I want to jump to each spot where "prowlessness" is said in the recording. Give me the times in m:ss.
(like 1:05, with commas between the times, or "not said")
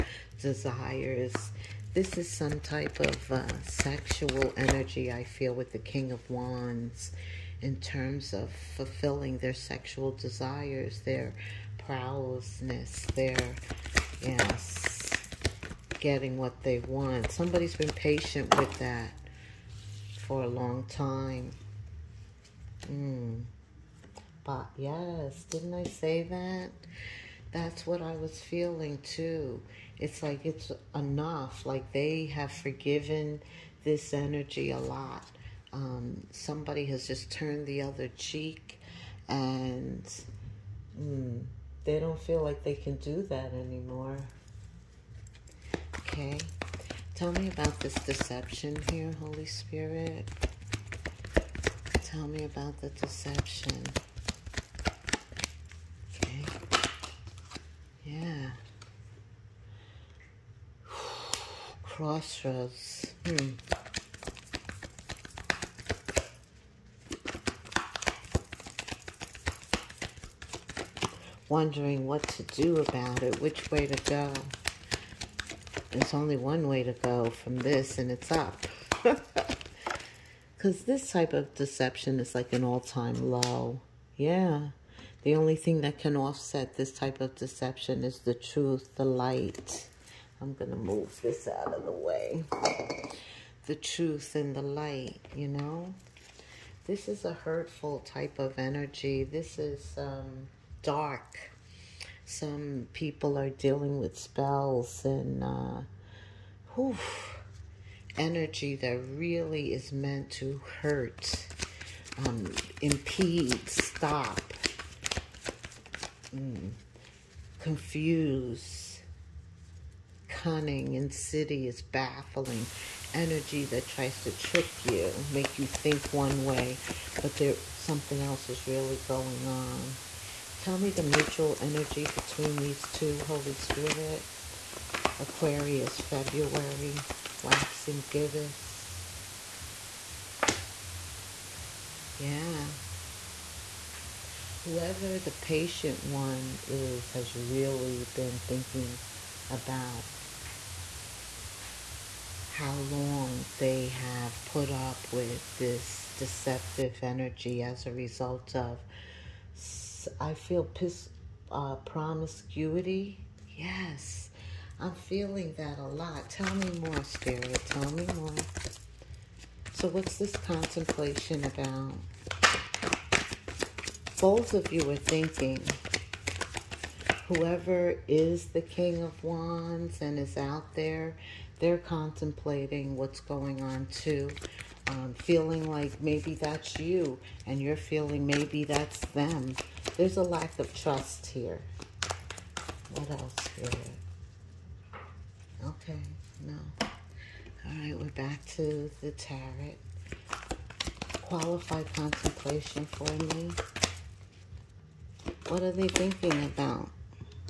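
0:11.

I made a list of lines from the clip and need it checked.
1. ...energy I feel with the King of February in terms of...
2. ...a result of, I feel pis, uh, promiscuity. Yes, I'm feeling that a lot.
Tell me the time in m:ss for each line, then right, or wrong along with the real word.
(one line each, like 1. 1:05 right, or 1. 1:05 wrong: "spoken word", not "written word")
1. 0:04 wrong: "Wands", not "February"
2. 2:37 right.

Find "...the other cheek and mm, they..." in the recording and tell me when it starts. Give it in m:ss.
0:37.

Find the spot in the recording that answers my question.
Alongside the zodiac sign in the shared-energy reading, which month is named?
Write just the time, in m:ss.
2:15.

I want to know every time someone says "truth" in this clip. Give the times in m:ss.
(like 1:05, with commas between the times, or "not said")
1:28, 1:33.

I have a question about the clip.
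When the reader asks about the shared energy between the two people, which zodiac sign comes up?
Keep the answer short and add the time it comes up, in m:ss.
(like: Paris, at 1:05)
Aquarius, at 2:15.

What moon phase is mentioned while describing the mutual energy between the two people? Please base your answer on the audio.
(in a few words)
Waxing gibbous.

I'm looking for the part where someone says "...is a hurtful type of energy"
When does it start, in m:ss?
1:37.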